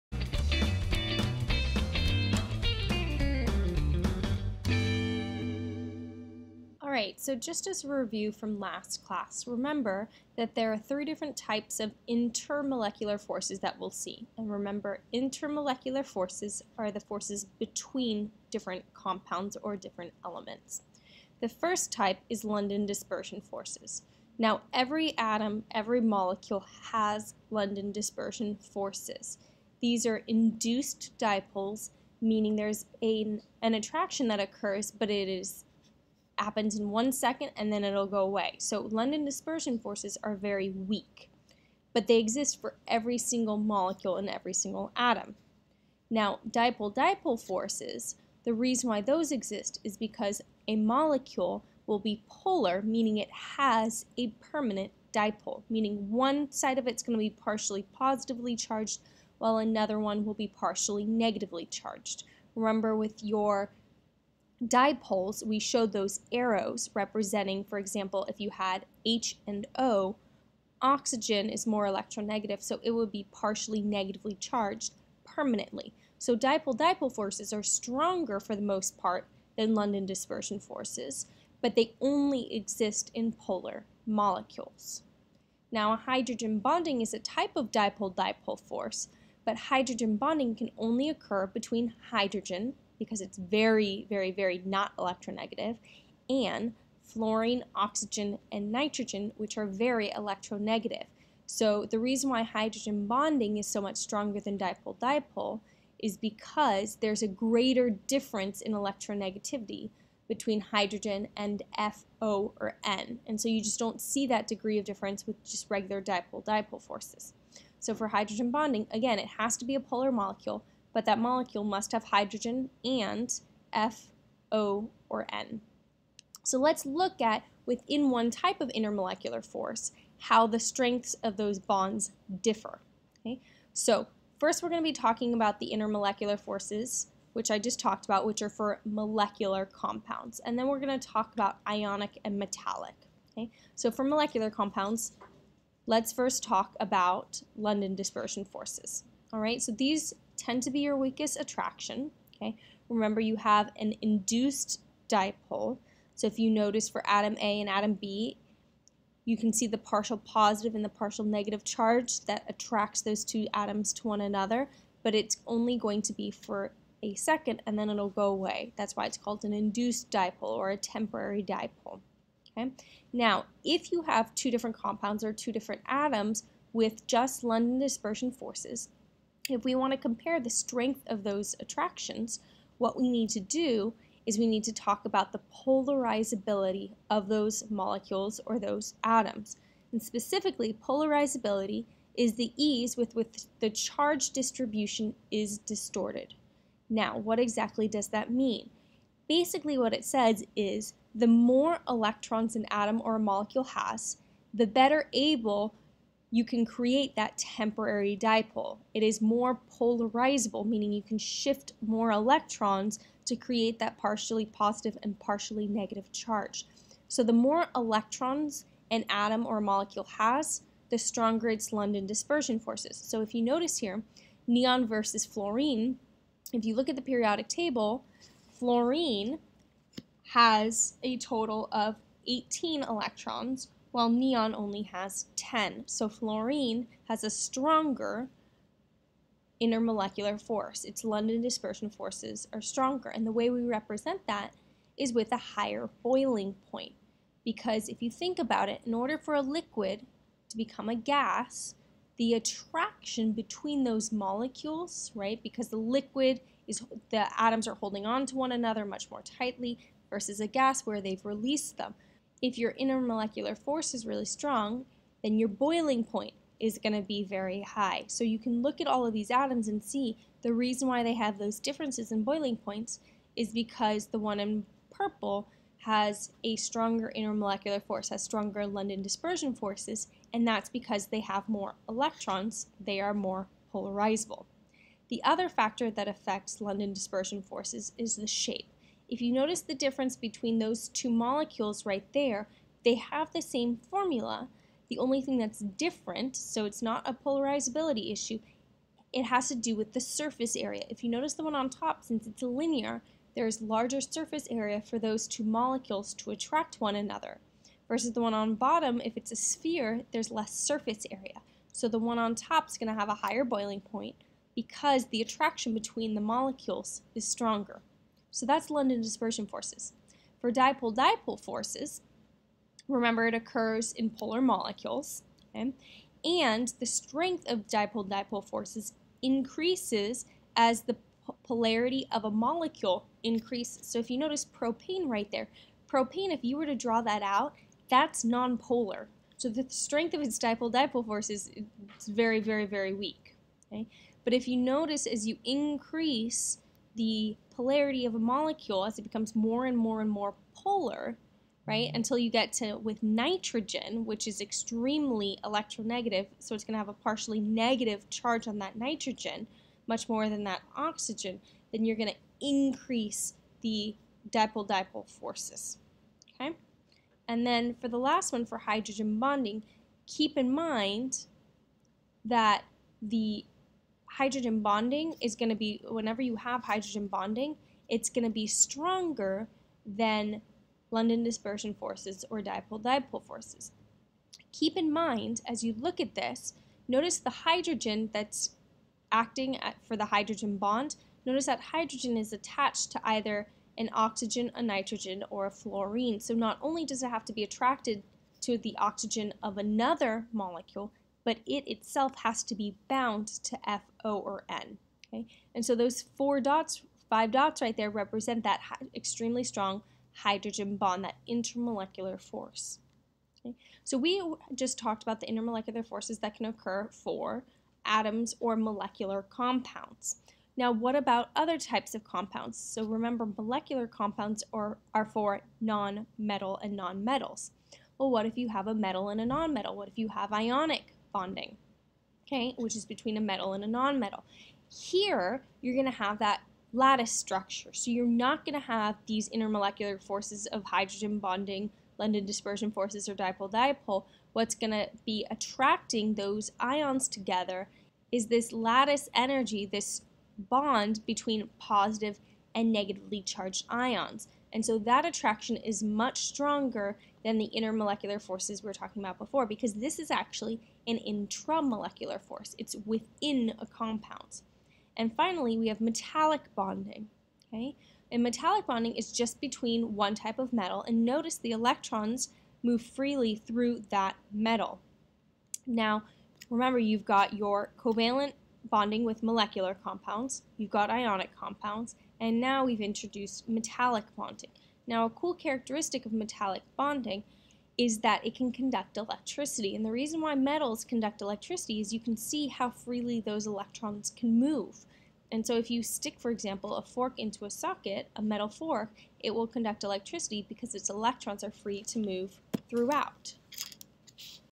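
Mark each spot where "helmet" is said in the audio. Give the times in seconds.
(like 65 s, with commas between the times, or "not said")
not said.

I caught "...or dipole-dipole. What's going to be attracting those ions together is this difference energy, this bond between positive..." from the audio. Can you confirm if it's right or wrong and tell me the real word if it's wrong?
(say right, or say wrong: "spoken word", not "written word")
wrong: "lattice", not "difference".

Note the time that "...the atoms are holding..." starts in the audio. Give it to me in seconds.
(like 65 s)
257 s.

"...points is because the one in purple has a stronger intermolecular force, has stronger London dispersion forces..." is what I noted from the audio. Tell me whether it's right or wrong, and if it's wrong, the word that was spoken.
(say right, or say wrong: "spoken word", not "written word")
right.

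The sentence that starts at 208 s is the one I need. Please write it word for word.
It is more polarizable, meaning you can shift more electrons to create that partially positive and partially negative charge.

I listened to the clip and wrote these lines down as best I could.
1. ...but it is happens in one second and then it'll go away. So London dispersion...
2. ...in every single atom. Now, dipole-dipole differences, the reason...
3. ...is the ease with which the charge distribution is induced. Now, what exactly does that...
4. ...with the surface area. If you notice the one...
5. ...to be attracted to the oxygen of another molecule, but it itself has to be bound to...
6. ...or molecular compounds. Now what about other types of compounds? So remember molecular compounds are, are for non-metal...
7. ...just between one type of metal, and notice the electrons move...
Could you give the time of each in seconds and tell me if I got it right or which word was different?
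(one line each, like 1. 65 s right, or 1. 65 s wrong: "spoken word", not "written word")
1. 34 s right
2. 44 s wrong: "forces", not "differences"
3. 192 s wrong: "distorted", not "induced"
4. 299 s right
5. 397 s right
6. 418 s right
7. 469 s right.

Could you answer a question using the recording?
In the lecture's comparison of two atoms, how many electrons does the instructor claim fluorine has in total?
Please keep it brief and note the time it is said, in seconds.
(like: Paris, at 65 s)
18, at 232 s.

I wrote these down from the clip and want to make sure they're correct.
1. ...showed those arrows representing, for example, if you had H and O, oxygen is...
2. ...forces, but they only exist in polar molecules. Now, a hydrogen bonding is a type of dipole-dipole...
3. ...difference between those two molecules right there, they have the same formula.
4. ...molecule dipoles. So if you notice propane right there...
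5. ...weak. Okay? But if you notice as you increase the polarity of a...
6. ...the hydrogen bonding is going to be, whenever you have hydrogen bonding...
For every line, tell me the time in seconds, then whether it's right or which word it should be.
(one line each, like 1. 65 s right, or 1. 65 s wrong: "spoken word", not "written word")
1. 65 s right
2. 80 s right
3. 289 s right
4. 332 s wrong: "increases", not "dipoles"
5. 342 s right
6. 373 s right.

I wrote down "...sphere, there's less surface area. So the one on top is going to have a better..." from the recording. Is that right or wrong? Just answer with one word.
wrong.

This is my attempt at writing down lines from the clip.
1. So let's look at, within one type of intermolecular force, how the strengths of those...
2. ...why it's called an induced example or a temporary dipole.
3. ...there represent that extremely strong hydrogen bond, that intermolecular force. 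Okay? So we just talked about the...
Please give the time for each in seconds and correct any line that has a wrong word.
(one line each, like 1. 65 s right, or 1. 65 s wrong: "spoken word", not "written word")
1. 126 s right
2. 168 s wrong: "dipole", not "example"
3. 407 s right.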